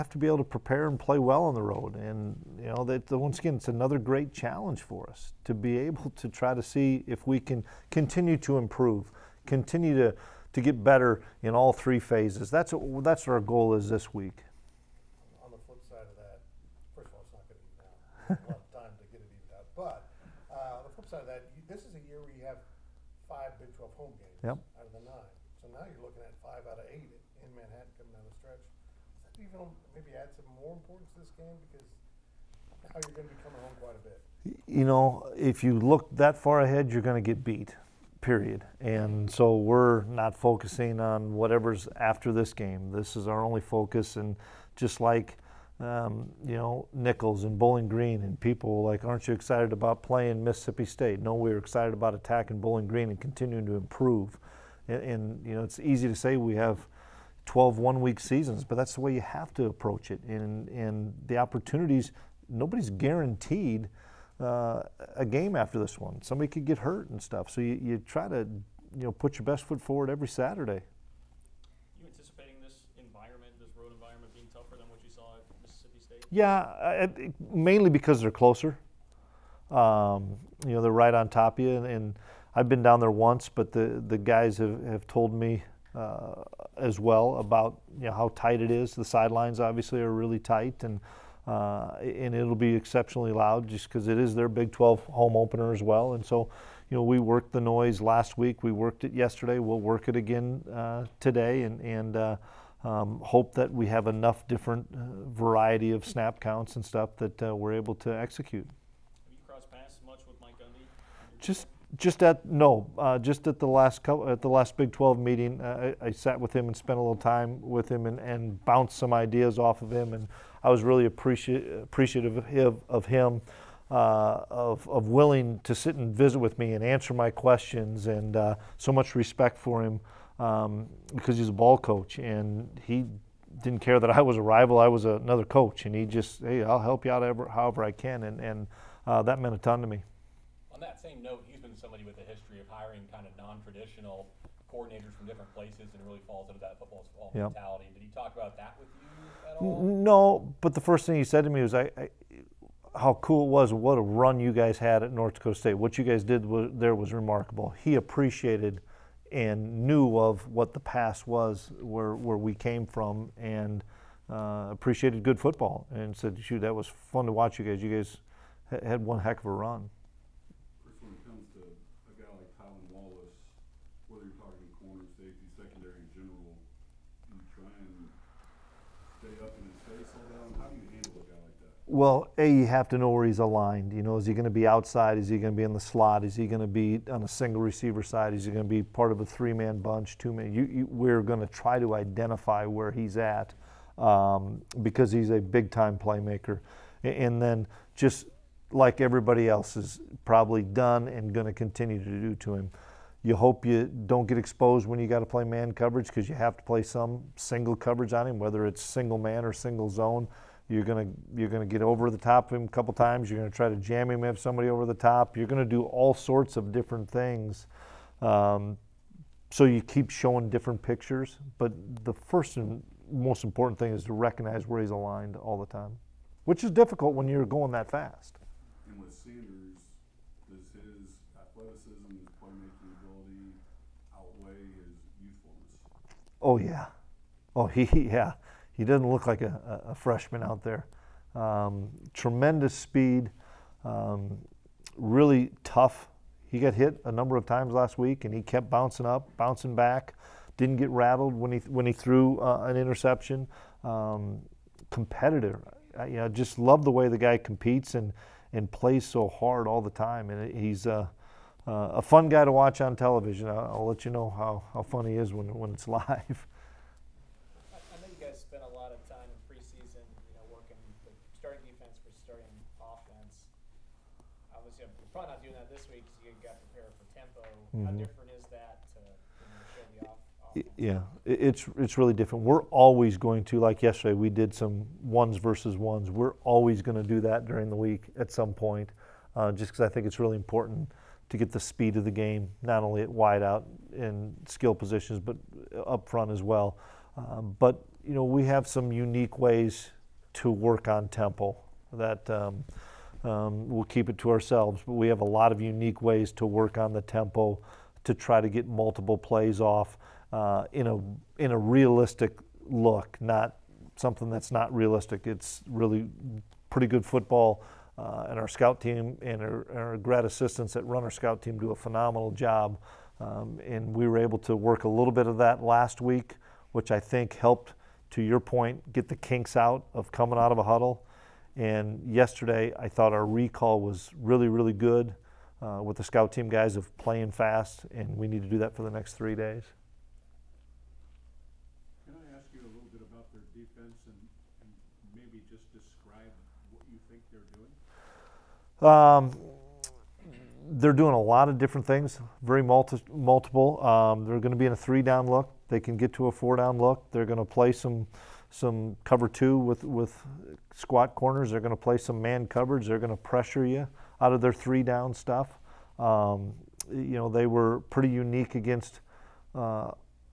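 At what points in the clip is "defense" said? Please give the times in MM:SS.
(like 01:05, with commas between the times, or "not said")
04:31, 05:43.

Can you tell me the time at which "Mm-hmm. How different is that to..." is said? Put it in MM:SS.
04:37.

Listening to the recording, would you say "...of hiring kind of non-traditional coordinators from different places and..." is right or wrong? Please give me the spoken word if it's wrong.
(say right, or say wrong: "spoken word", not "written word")
right.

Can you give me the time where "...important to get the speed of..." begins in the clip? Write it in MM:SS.
04:50.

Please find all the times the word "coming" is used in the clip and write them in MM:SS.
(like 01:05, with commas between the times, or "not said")
00:27, 00:33, 05:30.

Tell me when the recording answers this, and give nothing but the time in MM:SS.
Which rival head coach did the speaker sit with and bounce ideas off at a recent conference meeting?
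01:50.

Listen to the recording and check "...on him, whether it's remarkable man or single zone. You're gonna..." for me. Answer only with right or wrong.
wrong.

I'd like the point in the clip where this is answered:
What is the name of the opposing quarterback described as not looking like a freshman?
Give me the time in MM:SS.
03:49.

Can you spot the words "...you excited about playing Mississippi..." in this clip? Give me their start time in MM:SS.
00:49.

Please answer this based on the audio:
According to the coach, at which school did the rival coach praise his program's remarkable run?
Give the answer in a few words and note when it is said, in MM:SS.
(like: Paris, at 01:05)
North Dakota State, at 02:35.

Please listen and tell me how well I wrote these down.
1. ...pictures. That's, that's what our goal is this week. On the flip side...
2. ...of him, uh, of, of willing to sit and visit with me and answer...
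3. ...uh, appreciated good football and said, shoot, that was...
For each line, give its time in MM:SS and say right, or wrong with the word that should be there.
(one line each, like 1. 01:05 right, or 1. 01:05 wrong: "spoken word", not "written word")
1. 00:11 wrong: "phases", not "pictures"
2. 02:02 right
3. 02:44 right.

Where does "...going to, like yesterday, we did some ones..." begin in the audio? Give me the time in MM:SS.
04:43.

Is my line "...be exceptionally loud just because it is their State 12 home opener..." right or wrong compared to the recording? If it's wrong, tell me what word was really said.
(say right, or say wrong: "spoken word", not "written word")
wrong: "Big", not "State".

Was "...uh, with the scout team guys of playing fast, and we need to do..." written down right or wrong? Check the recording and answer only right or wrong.
right.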